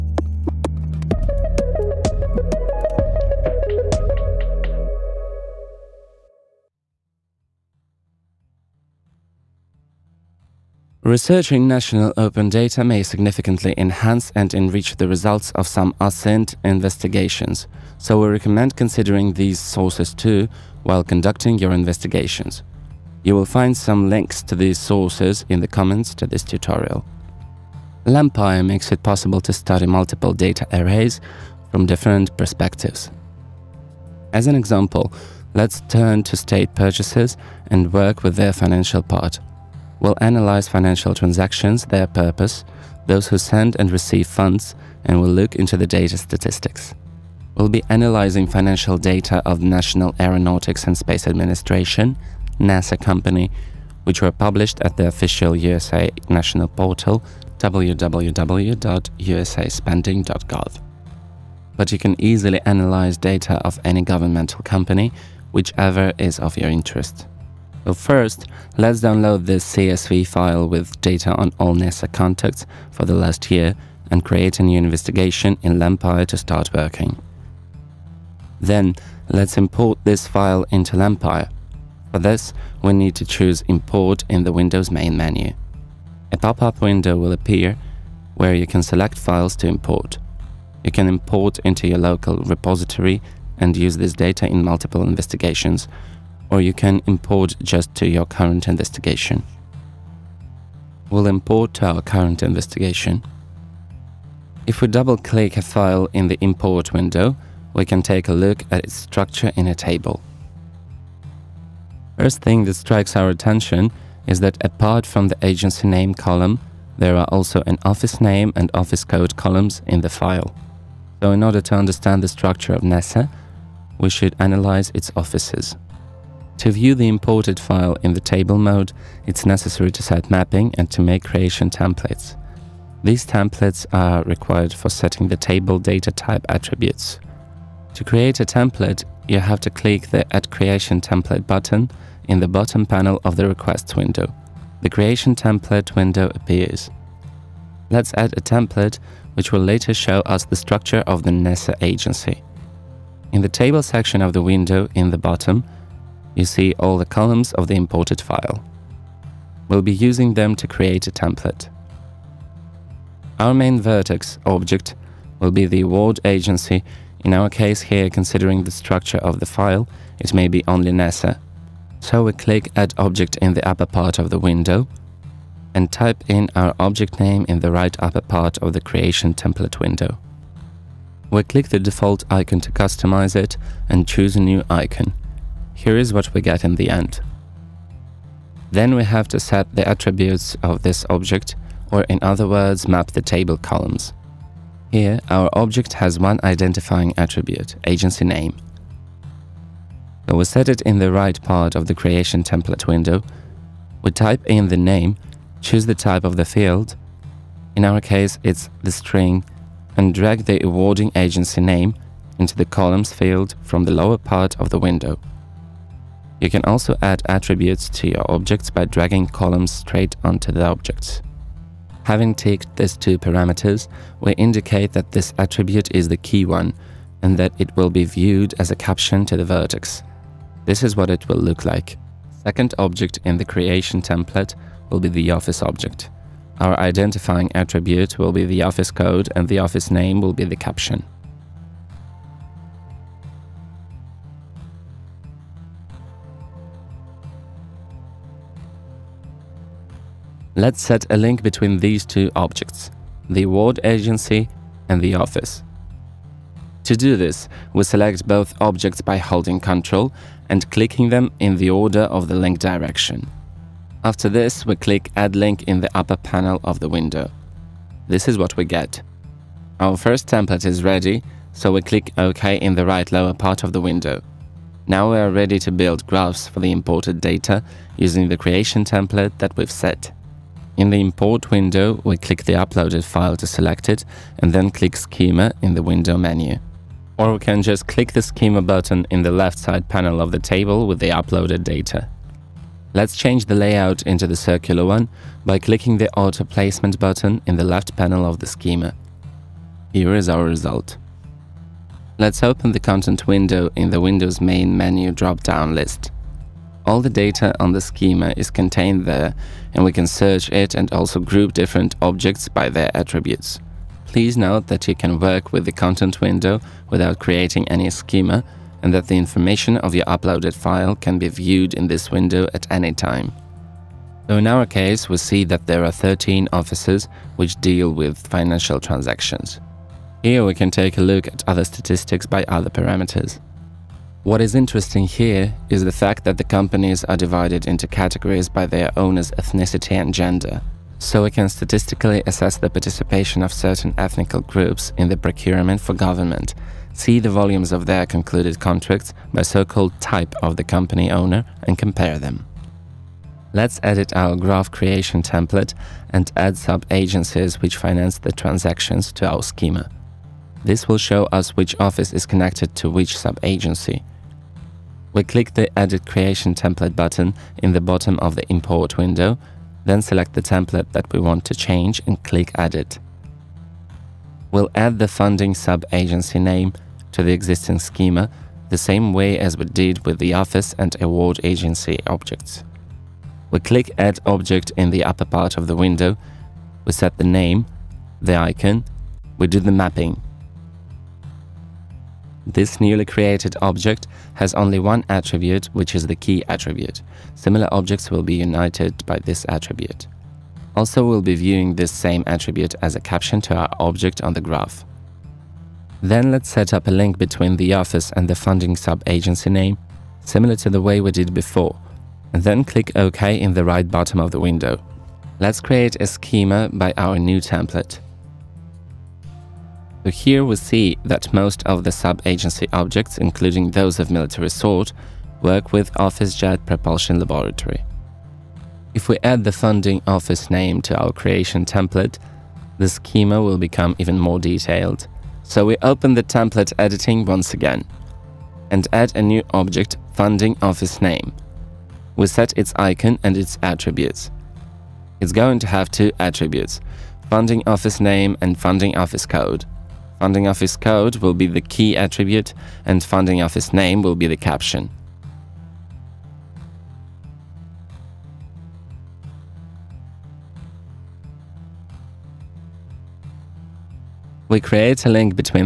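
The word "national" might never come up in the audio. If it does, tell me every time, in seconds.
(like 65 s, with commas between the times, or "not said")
11 s, 49 s, 56 s.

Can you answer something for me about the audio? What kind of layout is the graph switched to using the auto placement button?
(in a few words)
circular.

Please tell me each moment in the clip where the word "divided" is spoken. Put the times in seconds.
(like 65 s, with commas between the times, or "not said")
337 s.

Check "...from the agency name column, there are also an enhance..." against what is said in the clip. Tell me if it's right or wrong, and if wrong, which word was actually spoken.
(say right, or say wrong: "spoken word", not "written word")
wrong: "office", not "enhance".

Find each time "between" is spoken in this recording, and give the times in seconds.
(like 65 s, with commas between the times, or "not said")
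251 s, 407 s.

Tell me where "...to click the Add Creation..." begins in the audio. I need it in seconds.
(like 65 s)
139 s.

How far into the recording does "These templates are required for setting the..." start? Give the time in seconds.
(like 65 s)
133 s.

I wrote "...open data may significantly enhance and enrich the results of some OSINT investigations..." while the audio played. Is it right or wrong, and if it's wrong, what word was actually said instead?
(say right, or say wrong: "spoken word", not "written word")
right.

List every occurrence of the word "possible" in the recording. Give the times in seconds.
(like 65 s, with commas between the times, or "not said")
29 s.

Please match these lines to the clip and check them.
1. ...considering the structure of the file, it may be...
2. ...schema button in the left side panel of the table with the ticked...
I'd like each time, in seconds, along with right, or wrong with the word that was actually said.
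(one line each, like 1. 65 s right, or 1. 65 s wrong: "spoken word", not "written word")
1. 168 s right
2. 288 s wrong: "uploaded", not "ticked".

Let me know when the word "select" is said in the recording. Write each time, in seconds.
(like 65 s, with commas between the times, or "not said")
88 s, 257 s, 283 s, 370 s.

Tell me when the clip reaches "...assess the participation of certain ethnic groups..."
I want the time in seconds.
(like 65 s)
342 s.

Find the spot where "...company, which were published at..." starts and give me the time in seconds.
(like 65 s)
53 s.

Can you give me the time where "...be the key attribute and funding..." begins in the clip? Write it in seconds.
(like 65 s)
451 s.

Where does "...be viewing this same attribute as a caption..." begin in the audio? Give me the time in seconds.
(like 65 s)
401 s.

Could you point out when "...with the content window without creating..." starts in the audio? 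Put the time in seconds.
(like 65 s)
315 s.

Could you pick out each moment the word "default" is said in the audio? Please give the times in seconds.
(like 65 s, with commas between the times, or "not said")
181 s.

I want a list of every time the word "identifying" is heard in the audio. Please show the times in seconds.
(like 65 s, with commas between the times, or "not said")
196 s, 236 s.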